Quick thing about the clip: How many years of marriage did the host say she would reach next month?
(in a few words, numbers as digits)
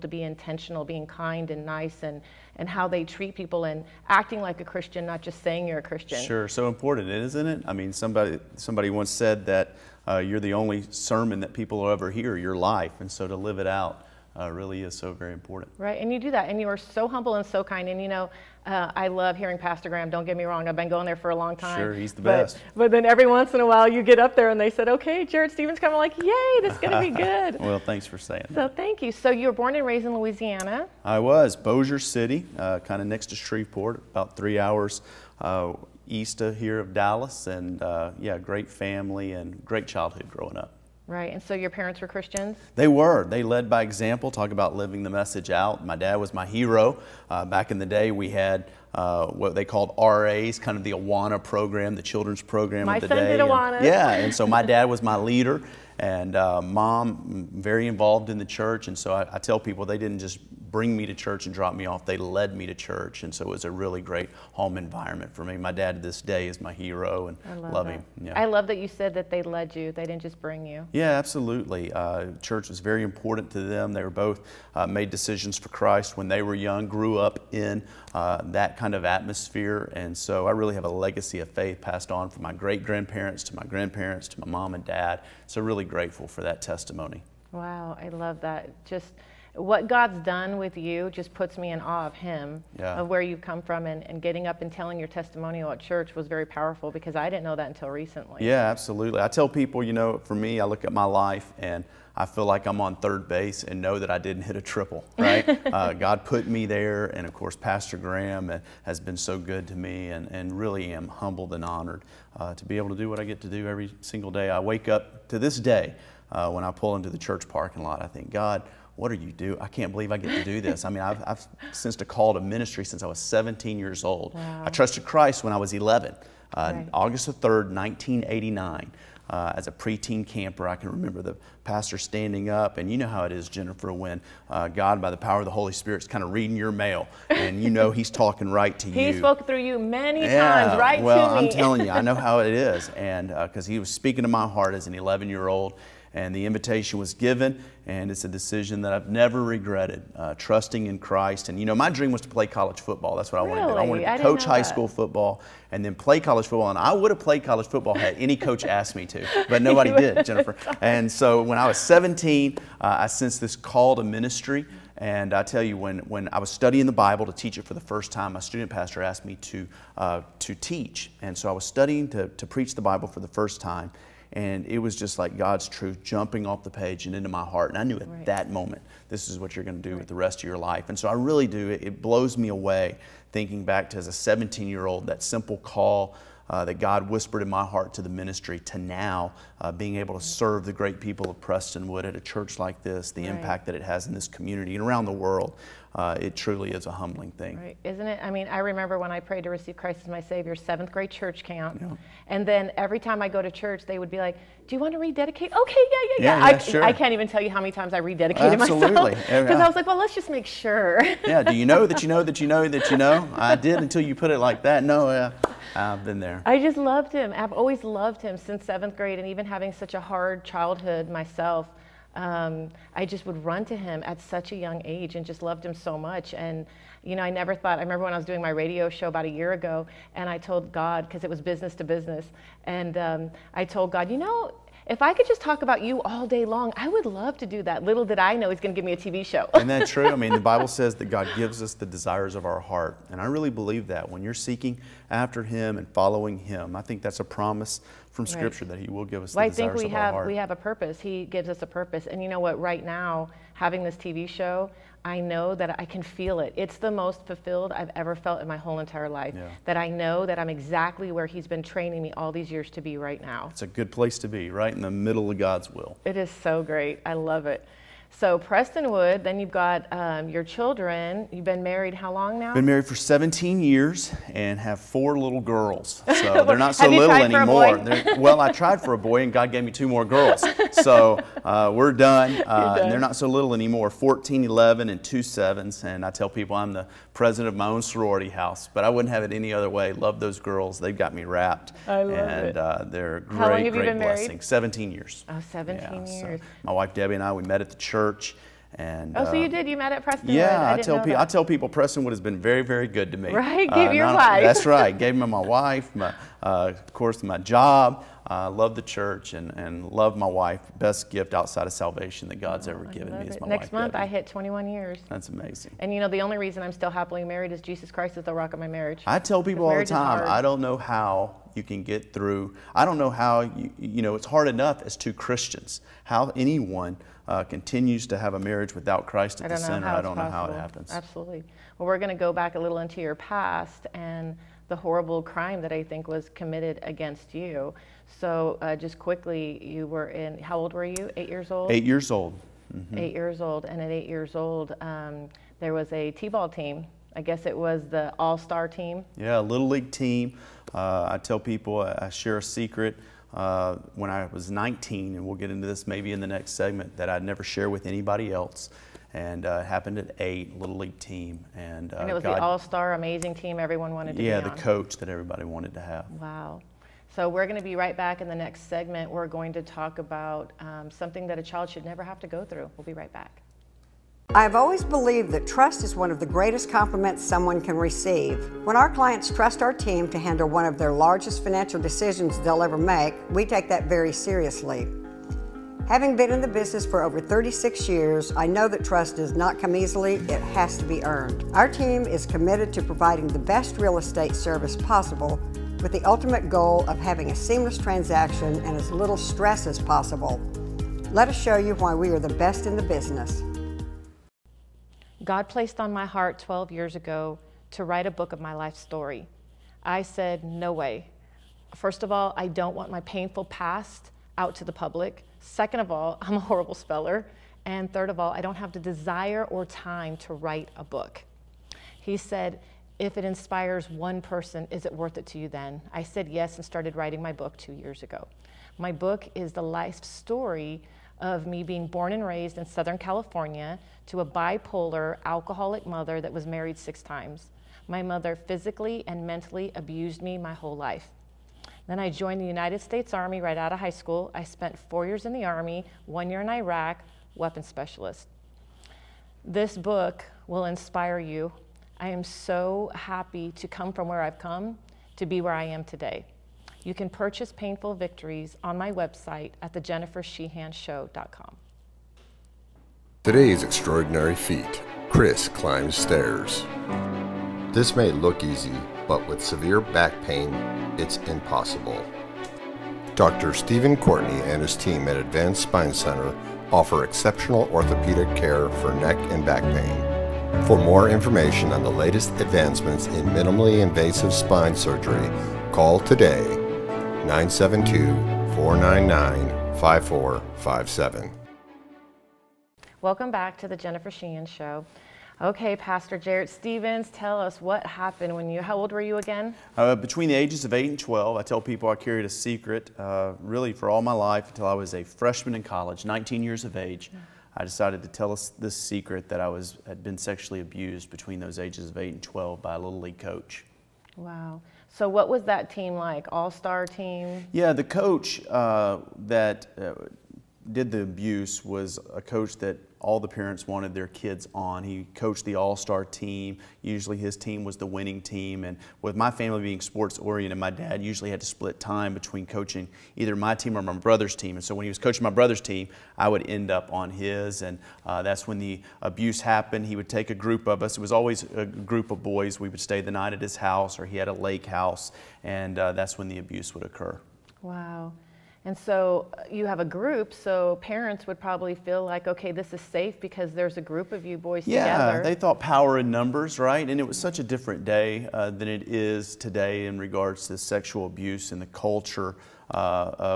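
21.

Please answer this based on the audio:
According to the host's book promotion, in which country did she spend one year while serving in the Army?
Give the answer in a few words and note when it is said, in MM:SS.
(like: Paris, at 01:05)
Iraq, at 07:26.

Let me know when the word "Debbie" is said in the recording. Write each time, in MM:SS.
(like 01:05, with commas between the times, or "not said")
04:56, 05:13.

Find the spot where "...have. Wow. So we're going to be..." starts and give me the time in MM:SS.
06:05.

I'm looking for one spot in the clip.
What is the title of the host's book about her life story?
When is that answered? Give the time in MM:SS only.
07:37.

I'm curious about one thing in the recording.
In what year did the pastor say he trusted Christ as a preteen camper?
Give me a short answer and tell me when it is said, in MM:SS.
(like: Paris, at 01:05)
1989, at 02:07.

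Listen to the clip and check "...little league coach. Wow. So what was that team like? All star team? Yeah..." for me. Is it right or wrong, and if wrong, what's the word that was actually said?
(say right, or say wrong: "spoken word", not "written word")
right.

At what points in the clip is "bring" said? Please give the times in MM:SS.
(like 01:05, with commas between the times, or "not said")
01:00, 01:10.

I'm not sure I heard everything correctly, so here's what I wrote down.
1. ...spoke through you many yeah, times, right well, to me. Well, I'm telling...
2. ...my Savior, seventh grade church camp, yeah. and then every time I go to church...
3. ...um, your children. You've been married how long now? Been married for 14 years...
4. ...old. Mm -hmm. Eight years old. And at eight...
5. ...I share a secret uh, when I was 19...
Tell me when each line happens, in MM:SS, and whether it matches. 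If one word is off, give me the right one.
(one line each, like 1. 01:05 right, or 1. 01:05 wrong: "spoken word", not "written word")
1. 02:19 right
2. 03:20 right
3. 04:29 wrong: "17", not "14"
4. 05:42 right
5. 05:52 right.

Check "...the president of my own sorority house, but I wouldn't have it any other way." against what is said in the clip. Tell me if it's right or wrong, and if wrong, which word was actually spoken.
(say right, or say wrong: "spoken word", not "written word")
right.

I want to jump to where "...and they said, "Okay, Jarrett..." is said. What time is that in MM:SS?
00:24.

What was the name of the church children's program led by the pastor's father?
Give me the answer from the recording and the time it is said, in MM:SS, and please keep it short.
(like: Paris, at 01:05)
RAs, at 00:49.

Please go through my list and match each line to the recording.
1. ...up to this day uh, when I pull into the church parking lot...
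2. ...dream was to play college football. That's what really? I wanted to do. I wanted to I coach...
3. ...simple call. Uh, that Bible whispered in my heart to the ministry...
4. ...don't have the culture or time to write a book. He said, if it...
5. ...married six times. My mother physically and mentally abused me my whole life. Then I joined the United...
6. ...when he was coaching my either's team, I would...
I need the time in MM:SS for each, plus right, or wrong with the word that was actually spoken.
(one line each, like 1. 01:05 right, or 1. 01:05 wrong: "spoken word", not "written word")
1. 01:54 right
2. 02:31 right
3. 03:05 wrong: "God", not "Bible"
4. 06:58 wrong: "desire", not "culture"
5. 07:16 right
6. 08:54 wrong: "brother", not "either".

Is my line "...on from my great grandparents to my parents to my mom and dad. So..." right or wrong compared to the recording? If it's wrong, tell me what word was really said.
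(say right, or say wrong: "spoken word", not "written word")
wrong: "grandparents", not "parents".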